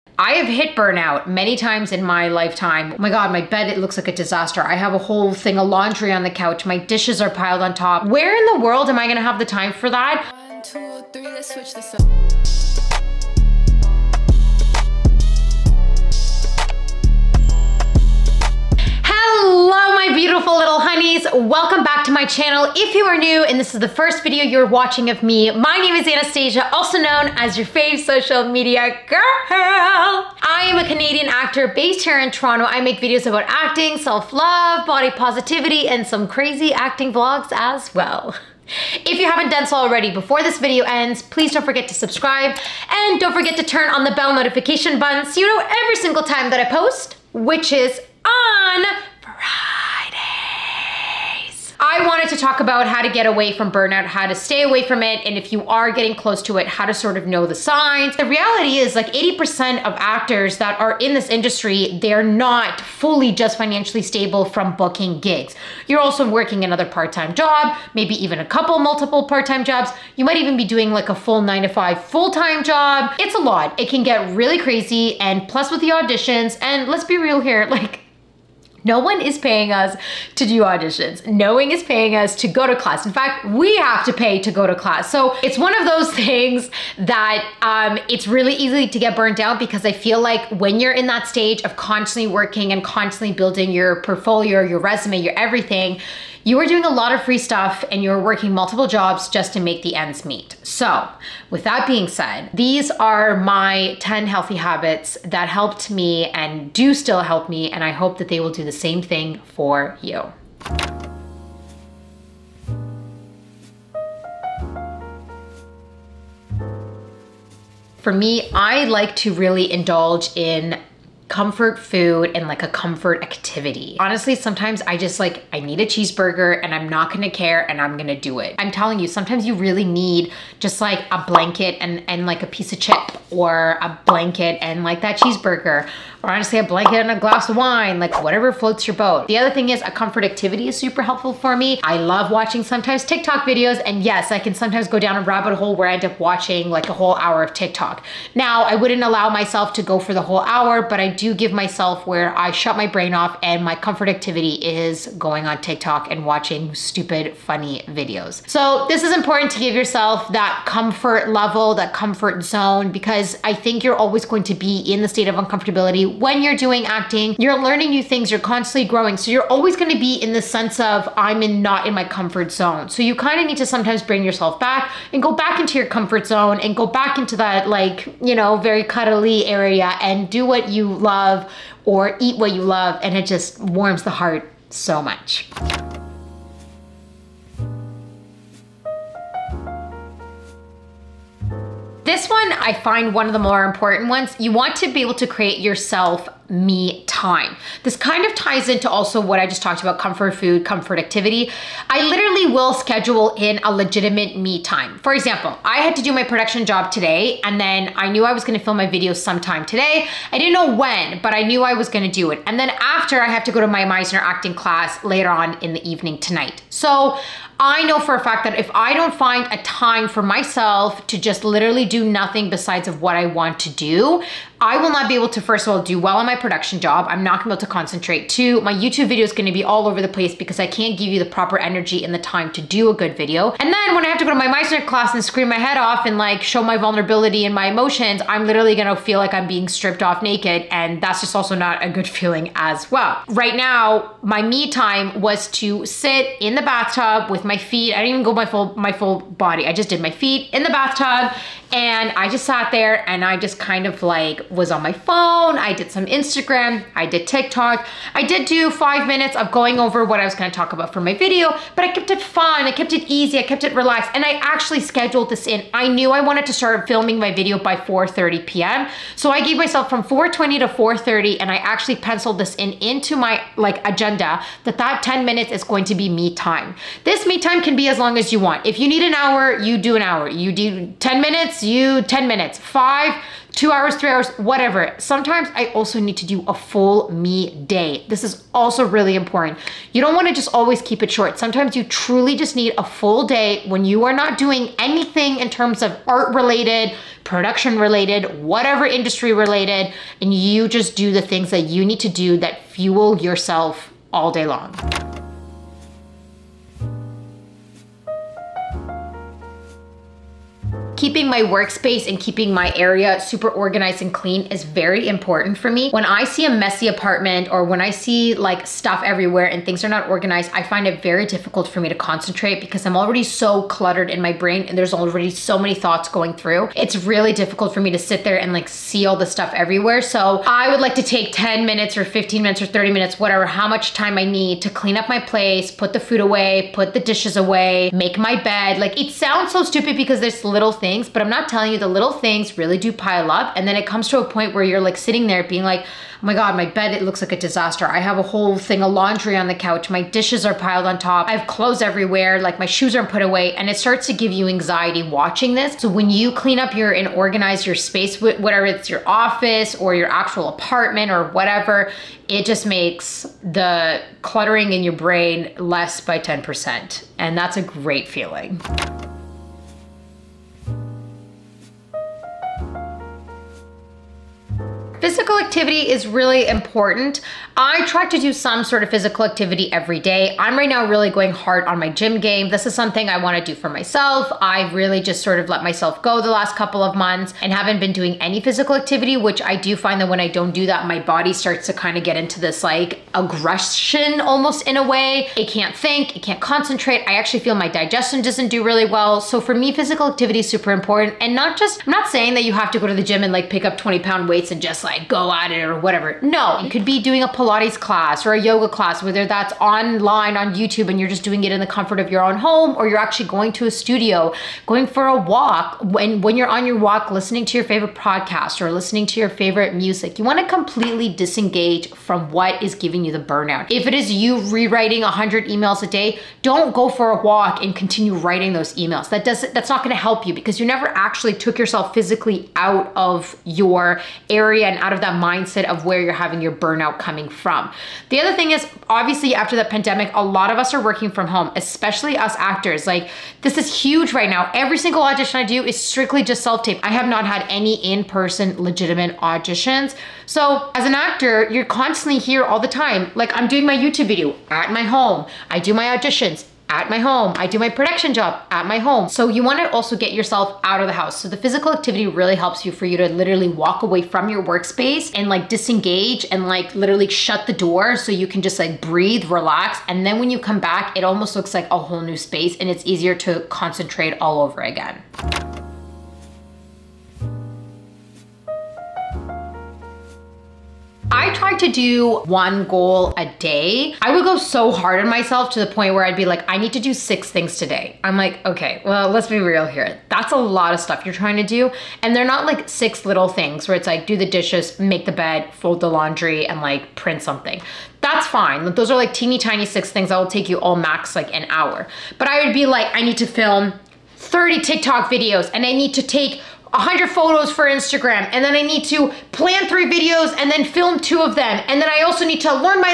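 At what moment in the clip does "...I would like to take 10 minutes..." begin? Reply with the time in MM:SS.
05:30.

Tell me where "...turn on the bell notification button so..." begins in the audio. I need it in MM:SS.
00:43.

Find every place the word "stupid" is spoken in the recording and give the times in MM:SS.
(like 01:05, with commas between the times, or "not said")
02:36, 05:39.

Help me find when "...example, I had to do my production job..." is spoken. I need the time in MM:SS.
03:25.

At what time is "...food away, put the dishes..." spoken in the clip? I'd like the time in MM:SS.
05:36.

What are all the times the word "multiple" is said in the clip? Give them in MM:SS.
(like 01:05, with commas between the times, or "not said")
01:08, 01:38.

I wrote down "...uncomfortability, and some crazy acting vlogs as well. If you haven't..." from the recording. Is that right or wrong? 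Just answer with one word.
wrong.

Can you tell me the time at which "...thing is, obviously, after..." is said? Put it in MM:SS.
07:18.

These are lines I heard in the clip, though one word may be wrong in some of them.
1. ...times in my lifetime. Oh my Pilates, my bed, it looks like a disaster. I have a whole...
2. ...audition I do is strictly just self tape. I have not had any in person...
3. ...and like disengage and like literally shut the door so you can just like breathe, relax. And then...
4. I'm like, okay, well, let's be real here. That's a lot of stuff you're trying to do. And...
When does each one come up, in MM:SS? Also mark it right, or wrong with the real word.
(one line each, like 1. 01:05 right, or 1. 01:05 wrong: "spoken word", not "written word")
1. 00:01 wrong: "God", not "Pilates"
2. 07:25 right
3. 07:45 right
4. 08:08 right.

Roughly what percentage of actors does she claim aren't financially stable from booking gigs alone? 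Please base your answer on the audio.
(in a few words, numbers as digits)
80%.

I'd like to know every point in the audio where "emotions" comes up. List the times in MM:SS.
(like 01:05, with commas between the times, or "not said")
03:57.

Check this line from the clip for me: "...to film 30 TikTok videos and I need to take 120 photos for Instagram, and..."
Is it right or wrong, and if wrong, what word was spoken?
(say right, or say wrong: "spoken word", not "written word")
wrong: "100", not "120".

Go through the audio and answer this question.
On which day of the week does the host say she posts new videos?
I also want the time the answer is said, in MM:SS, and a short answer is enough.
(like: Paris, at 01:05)
Fridays, at 00:49.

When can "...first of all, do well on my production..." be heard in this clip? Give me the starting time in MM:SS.
03:45.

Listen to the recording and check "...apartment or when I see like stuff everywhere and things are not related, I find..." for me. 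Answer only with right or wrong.
wrong.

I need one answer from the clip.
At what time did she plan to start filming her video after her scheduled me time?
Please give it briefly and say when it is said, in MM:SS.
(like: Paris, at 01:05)
4:30 p.m., at 04:27.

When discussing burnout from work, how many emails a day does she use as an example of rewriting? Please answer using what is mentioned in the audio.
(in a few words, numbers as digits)
100.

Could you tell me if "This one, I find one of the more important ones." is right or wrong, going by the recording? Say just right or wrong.
right.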